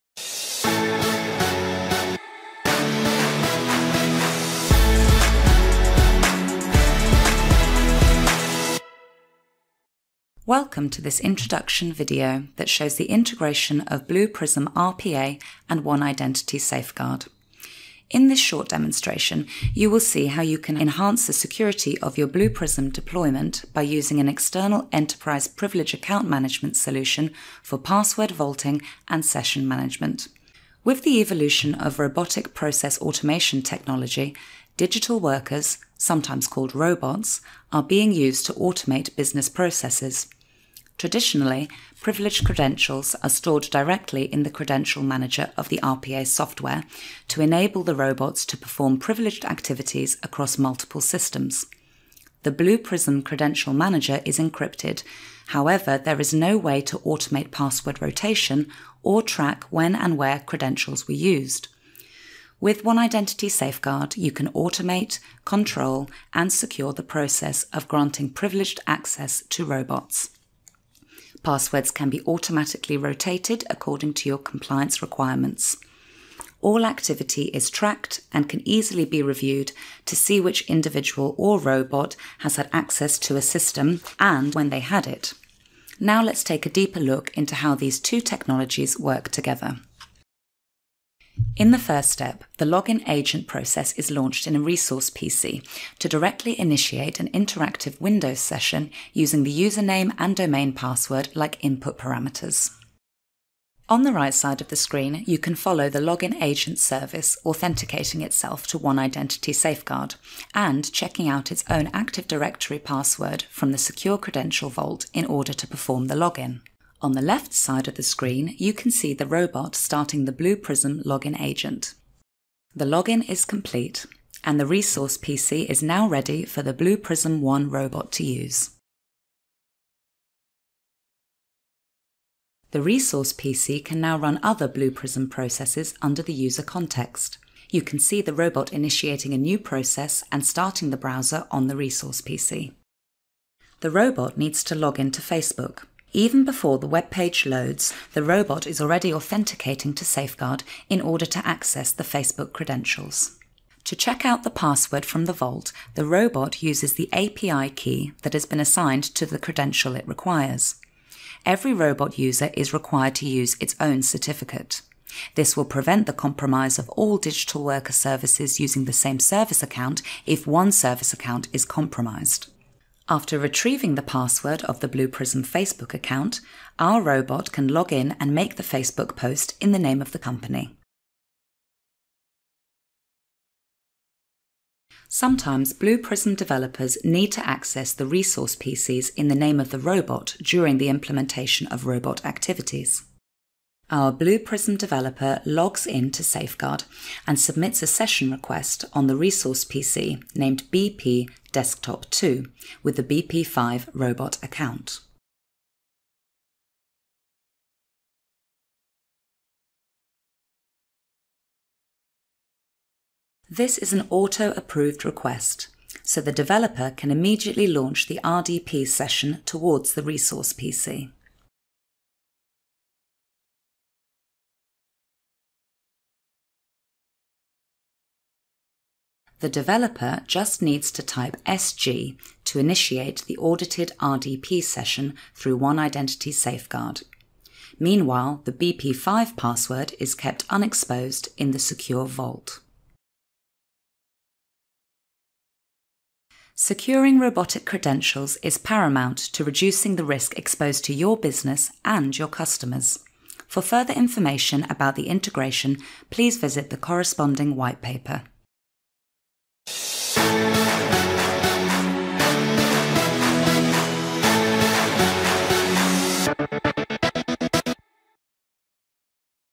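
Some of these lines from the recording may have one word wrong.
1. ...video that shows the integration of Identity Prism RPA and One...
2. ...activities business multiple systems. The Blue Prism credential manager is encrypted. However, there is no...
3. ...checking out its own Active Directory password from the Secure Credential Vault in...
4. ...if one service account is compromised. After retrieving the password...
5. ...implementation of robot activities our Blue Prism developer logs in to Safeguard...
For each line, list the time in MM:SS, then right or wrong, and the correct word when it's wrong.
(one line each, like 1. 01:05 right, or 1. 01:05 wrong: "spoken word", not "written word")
1. 00:11 wrong: "Blue", not "Identity"
2. 00:49 wrong: "across", not "business"
3. 01:50 right
4. 02:50 right
5. 03:10 right.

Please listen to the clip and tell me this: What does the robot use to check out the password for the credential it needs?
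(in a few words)
API key.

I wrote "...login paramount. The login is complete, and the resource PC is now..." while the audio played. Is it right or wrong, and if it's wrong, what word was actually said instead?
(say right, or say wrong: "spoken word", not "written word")
wrong: "agent", not "paramount".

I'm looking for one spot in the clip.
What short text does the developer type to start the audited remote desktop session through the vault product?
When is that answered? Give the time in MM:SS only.
03:51.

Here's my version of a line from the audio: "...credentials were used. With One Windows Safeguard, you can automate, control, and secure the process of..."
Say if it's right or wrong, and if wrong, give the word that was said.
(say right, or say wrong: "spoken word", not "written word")
wrong: "Identity", not "Windows".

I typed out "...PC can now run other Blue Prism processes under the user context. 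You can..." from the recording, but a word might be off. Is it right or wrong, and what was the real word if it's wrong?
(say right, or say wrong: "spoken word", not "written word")
right.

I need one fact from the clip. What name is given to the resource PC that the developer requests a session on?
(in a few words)
BP Desktop 2.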